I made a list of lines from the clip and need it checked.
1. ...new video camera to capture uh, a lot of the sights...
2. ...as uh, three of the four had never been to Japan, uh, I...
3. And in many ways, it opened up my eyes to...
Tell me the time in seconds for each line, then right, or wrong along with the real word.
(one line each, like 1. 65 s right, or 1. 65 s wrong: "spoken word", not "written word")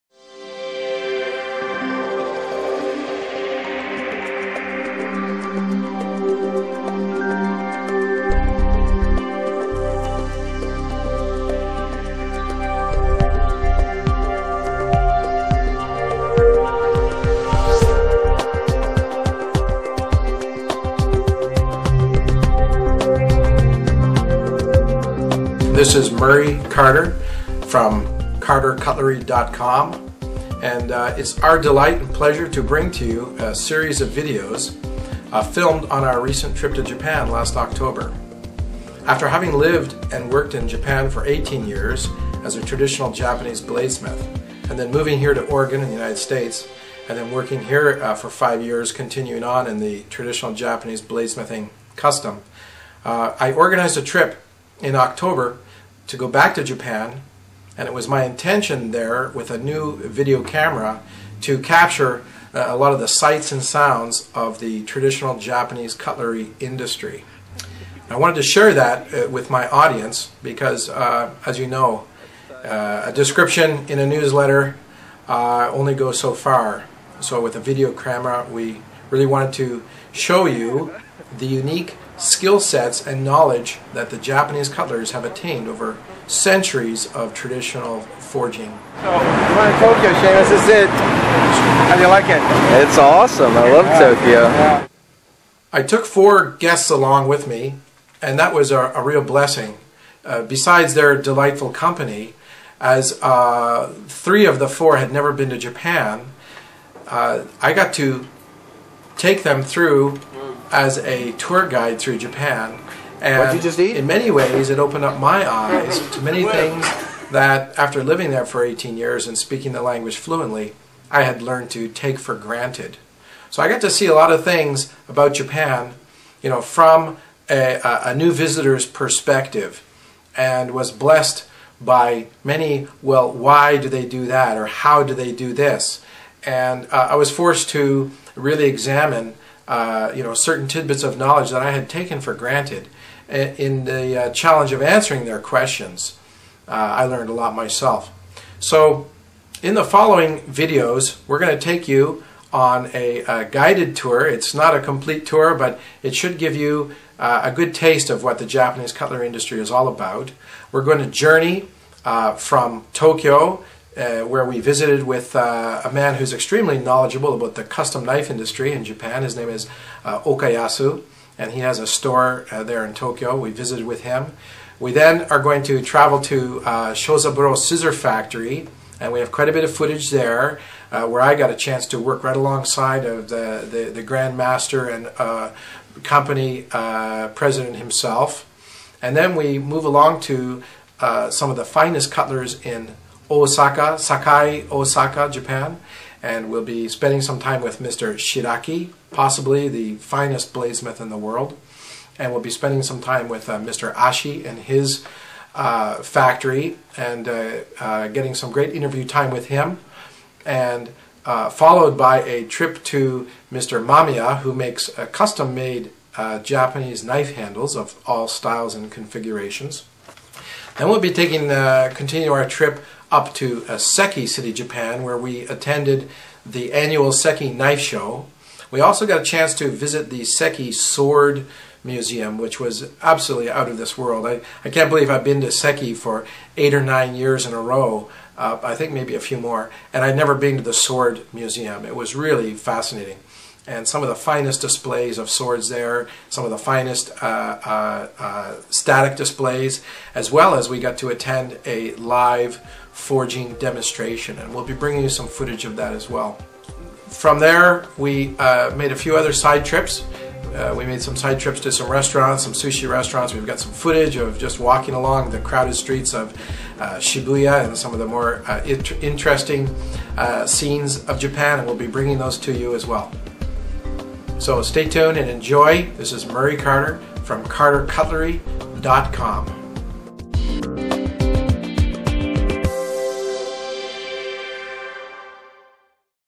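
1. 59 s right
2. 102 s right
3. 113 s right.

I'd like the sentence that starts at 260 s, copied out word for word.
Uh, we made some side trips to some restaurants, some sushi restaurants.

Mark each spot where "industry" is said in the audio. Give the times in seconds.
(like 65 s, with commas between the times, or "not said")
66 s, 159 s, 168 s.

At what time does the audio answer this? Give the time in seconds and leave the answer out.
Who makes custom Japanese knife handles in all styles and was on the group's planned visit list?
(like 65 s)
213 s.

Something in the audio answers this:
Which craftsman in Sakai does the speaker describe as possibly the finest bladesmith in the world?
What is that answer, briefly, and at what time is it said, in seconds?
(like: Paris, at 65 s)
Mr. Shiraki, at 197 s.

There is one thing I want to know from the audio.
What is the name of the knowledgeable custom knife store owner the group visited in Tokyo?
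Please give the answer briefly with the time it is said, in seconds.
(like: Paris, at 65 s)
Okayasu, at 170 s.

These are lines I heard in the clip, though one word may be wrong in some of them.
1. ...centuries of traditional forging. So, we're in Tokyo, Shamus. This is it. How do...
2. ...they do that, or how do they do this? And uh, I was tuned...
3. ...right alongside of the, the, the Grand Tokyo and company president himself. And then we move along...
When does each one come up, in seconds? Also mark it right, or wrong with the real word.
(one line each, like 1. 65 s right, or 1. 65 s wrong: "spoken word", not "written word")
1. 86 s right
2. 133 s wrong: "forced", not "tuned"
3. 182 s wrong: "Master", not "Tokyo".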